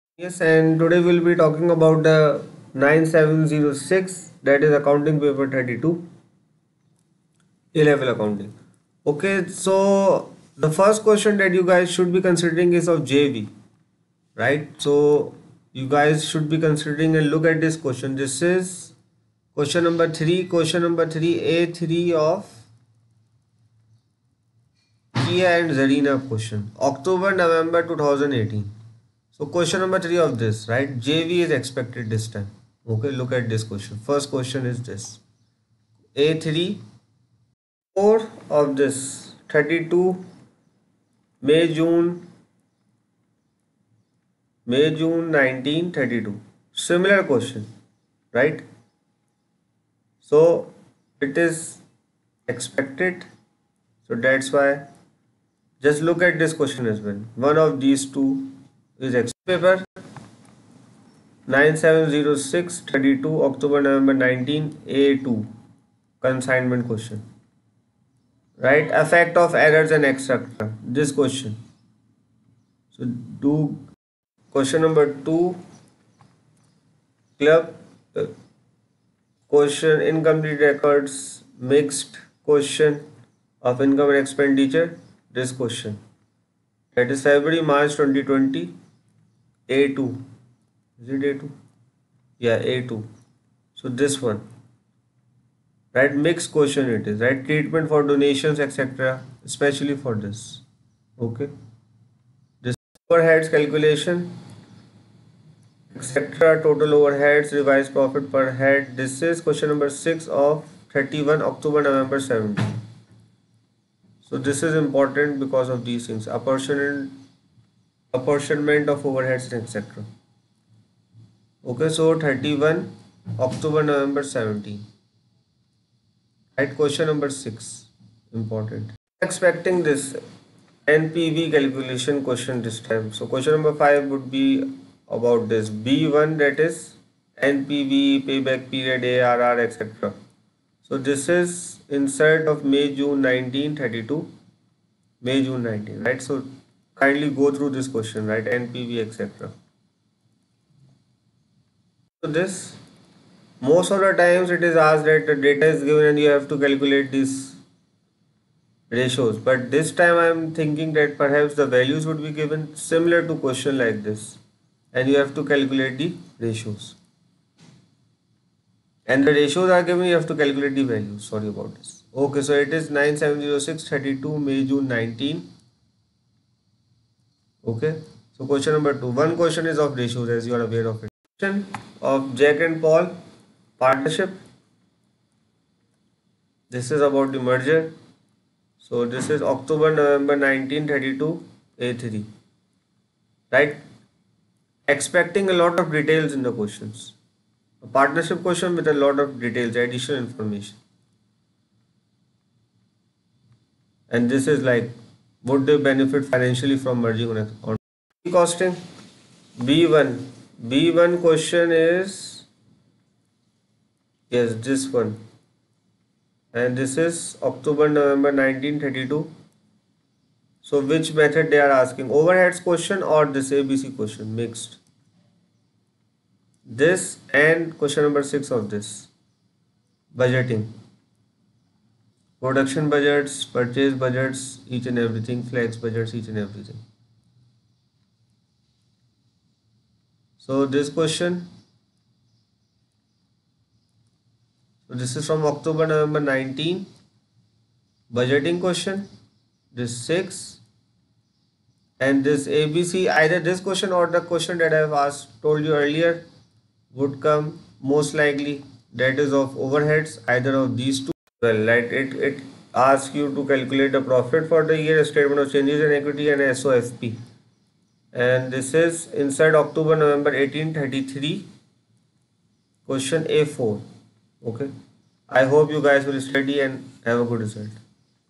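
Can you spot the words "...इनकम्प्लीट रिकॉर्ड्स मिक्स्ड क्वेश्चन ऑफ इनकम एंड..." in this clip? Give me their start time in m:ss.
1:20.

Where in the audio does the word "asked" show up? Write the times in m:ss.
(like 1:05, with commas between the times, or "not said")
2:34, 4:14.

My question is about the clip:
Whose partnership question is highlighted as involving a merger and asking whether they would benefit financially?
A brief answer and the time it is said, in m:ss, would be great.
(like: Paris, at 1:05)
Jack and Paul, at 3:02.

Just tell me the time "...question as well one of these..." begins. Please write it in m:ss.
0:56.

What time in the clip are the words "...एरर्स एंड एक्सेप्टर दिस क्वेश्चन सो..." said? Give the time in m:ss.
1:09.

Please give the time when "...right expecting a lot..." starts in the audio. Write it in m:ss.
3:13.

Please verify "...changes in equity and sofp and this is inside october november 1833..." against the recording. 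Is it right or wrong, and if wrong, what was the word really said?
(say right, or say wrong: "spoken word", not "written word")
right.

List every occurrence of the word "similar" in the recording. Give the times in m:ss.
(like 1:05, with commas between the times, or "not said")
0:46, 2:42.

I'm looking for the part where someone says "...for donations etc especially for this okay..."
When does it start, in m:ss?
1:37.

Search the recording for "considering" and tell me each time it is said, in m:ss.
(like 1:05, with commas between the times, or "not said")
0:12, 0:16.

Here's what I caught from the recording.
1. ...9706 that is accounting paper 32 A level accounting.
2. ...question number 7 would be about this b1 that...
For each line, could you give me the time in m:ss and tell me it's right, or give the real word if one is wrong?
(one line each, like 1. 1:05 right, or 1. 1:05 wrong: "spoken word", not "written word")
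1. 0:02 right
2. 2:13 wrong: "5", not "7".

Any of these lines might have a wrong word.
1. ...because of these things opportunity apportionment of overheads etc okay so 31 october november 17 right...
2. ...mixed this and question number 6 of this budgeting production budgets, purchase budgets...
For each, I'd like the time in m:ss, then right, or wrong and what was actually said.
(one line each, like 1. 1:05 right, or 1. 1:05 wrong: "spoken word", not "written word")
1. 1:55 right
2. 3:44 right.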